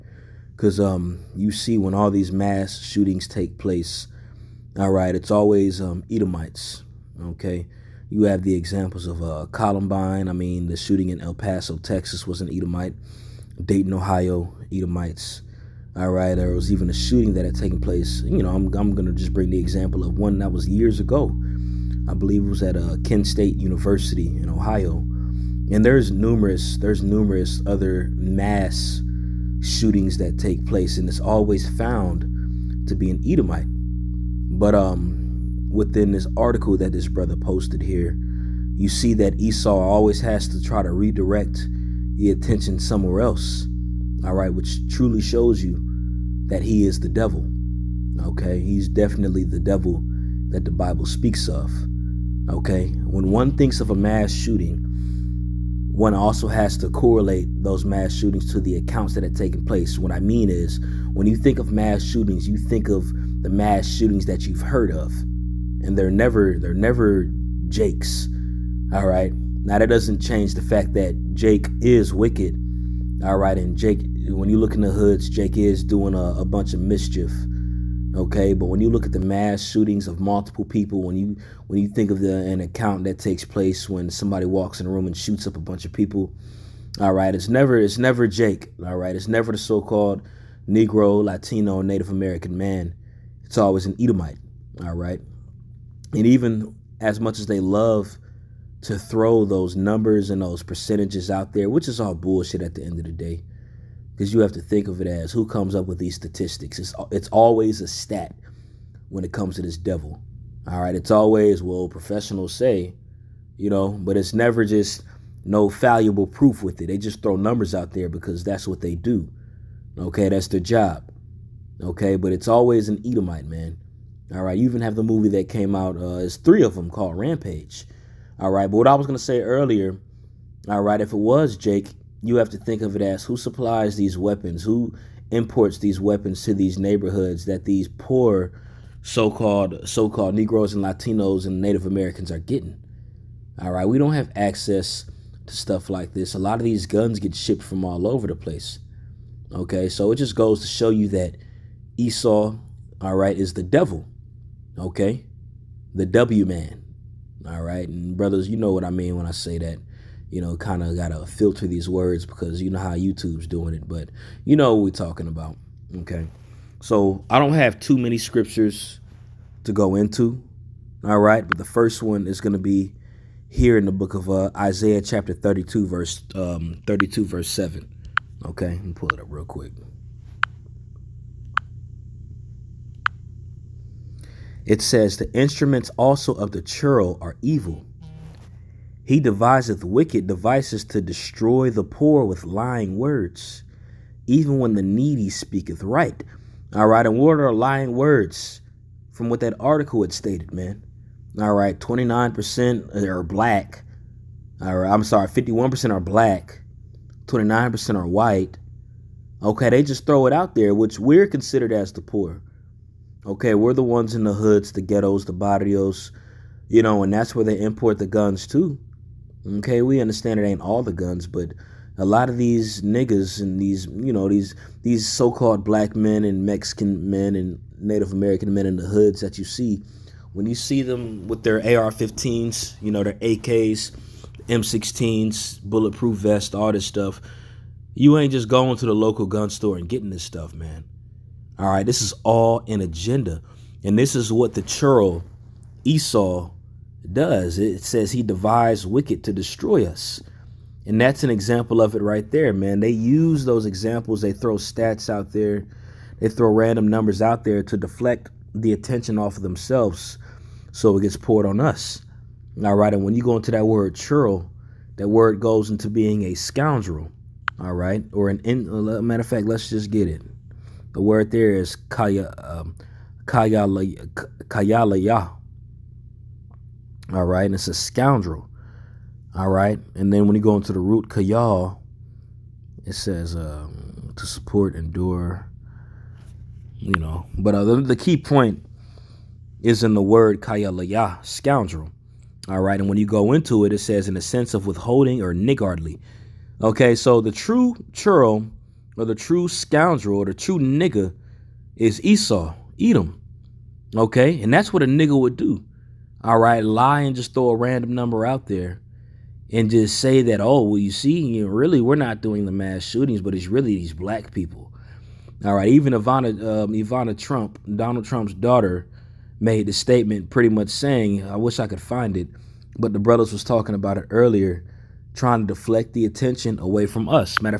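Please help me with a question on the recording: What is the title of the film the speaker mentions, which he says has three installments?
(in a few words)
Rampage.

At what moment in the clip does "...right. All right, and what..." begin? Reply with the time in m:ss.
3:15.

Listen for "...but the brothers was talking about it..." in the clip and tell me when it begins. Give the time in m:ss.
5:22.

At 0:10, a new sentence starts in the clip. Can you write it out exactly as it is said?
I mean, the shooting in El Paso, Texas was an Edomite.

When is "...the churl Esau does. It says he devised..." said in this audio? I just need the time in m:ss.
4:04.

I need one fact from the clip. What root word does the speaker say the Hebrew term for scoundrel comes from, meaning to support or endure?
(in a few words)
kayal.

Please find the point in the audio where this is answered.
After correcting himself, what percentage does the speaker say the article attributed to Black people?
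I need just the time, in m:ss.
3:25.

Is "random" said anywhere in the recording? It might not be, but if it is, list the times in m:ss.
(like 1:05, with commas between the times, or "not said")
4:16, 5:07.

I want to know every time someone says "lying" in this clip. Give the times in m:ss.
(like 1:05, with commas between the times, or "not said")
3:12, 3:17.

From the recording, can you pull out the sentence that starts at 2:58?
Okay, let me pull it up real quick.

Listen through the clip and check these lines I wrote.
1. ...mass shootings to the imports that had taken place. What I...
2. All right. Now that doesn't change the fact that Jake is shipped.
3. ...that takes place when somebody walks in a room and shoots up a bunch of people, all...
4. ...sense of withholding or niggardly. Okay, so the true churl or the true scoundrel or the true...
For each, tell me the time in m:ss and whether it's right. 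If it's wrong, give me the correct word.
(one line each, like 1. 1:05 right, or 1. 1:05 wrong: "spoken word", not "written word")
1. 0:57 wrong: "accounts", not "imports"
2. 1:08 wrong: "wicked", not "shipped"
3. 1:23 right
4. 4:54 right.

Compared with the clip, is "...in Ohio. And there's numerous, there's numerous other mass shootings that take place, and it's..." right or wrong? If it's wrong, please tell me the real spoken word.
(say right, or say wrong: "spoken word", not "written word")
right.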